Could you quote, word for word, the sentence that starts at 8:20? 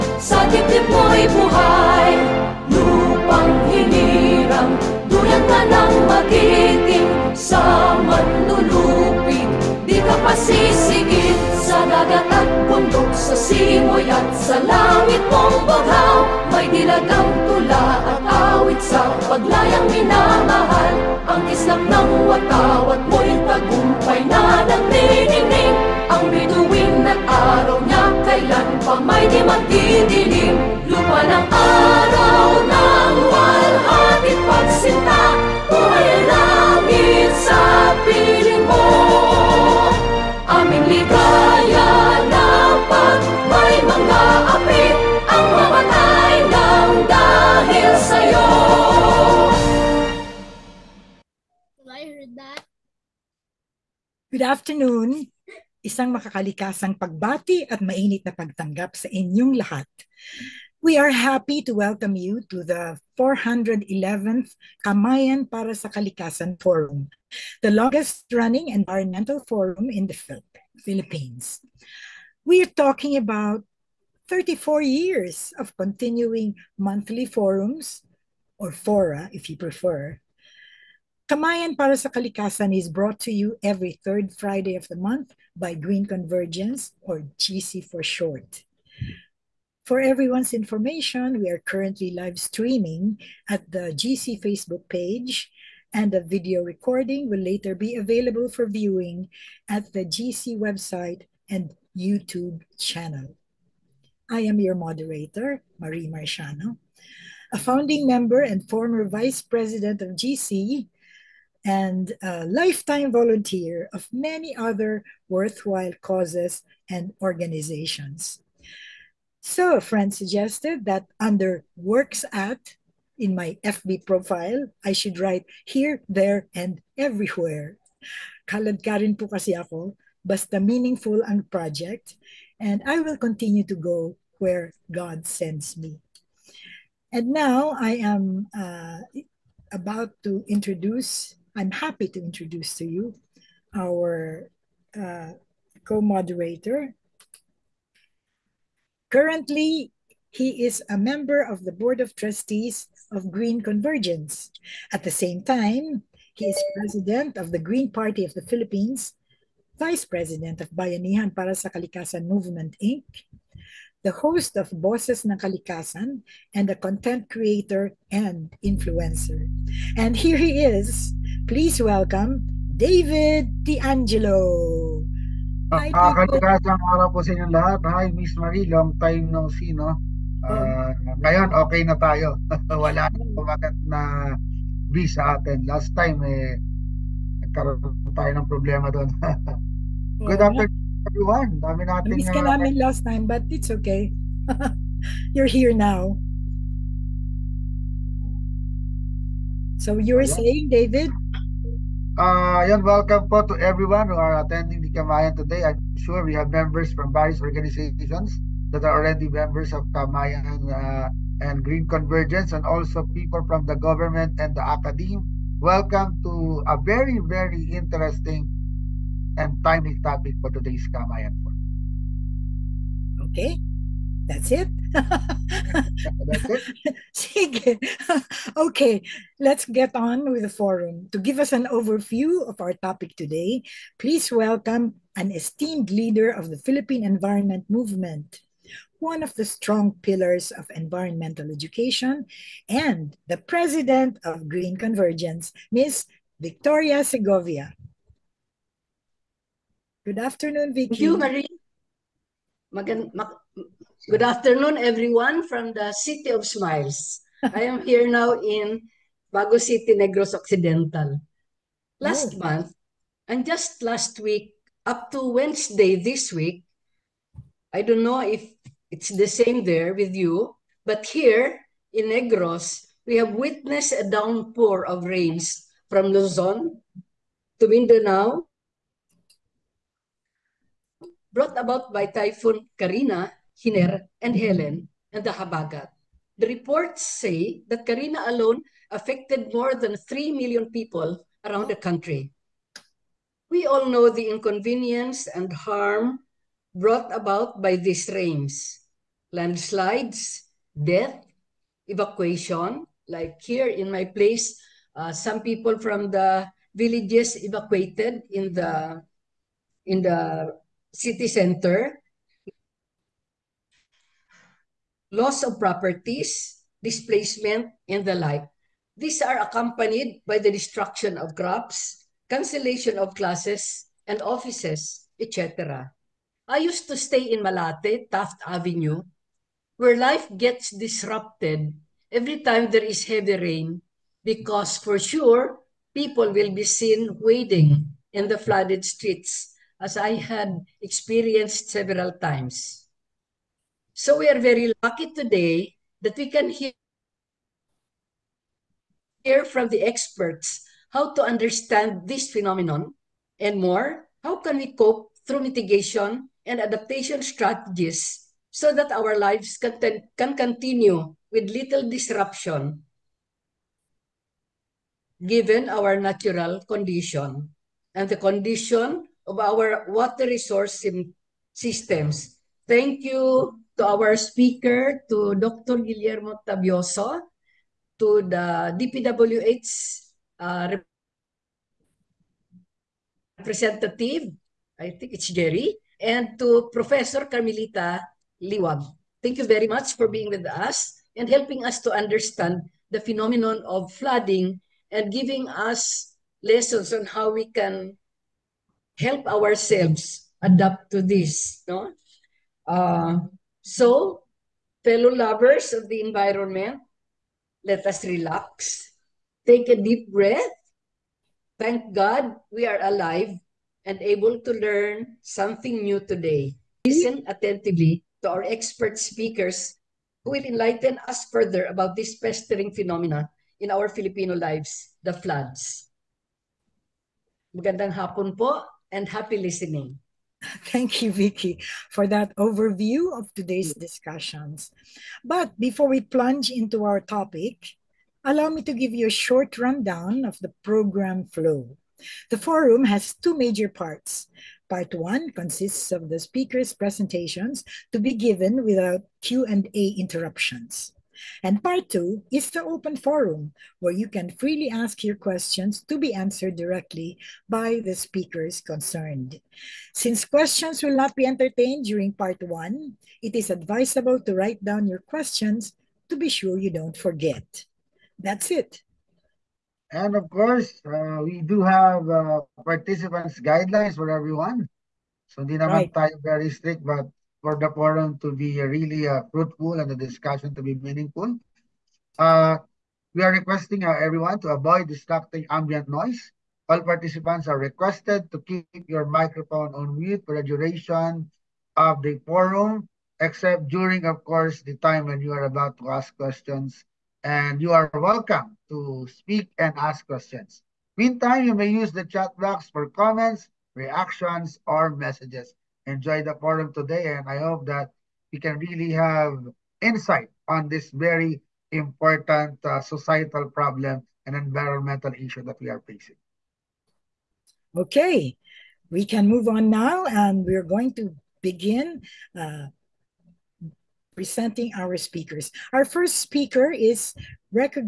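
Meantime, you may use the chat box for comments, reactions, or messages enjoy the forum today.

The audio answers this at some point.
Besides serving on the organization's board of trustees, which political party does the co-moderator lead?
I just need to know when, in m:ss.
2:37.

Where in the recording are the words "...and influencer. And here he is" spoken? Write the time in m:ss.
2:48.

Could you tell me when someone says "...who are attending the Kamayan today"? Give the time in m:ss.
3:24.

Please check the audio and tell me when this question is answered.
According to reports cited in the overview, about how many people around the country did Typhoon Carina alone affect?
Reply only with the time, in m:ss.
4:49.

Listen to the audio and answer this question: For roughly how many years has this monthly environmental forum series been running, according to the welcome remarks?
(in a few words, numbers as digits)
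34 years.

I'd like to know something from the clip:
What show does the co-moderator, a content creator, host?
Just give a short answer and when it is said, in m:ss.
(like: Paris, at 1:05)
Boses ng Kalikasan, at 2:44.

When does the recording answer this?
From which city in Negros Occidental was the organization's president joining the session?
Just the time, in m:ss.
4:19.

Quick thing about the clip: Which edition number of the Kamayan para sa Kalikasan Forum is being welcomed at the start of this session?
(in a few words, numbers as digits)
411th.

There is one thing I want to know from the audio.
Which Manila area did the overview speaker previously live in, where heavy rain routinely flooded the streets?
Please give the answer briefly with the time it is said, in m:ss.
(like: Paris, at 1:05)
Malate, at 5:27.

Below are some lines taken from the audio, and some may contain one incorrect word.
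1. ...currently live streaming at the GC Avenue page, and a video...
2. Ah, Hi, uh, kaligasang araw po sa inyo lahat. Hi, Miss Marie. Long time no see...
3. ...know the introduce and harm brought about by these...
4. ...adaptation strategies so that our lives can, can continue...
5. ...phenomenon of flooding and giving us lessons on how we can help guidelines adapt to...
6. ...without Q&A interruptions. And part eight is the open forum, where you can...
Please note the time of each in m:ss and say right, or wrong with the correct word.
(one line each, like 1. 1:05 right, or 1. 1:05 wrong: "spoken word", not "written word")
1. 1:31 wrong: "Facebook", not "Avenue"
2. 2:55 right
3. 4:53 wrong: "inconvenience", not "introduce"
4. 5:56 right
5. 6:32 wrong: "ourselves", not "guidelines"
6. 7:28 wrong: "two", not "eight".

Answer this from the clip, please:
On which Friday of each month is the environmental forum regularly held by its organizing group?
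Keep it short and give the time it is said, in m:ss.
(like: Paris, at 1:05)
third Friday, at 1:24.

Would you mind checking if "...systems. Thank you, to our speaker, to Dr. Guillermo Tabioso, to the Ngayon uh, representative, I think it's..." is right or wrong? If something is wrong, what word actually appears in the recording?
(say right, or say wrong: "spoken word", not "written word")
wrong: "DPWH", not "Ngayon".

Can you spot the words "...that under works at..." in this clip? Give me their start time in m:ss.
2:00.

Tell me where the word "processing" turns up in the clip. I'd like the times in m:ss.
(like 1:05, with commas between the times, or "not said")
not said.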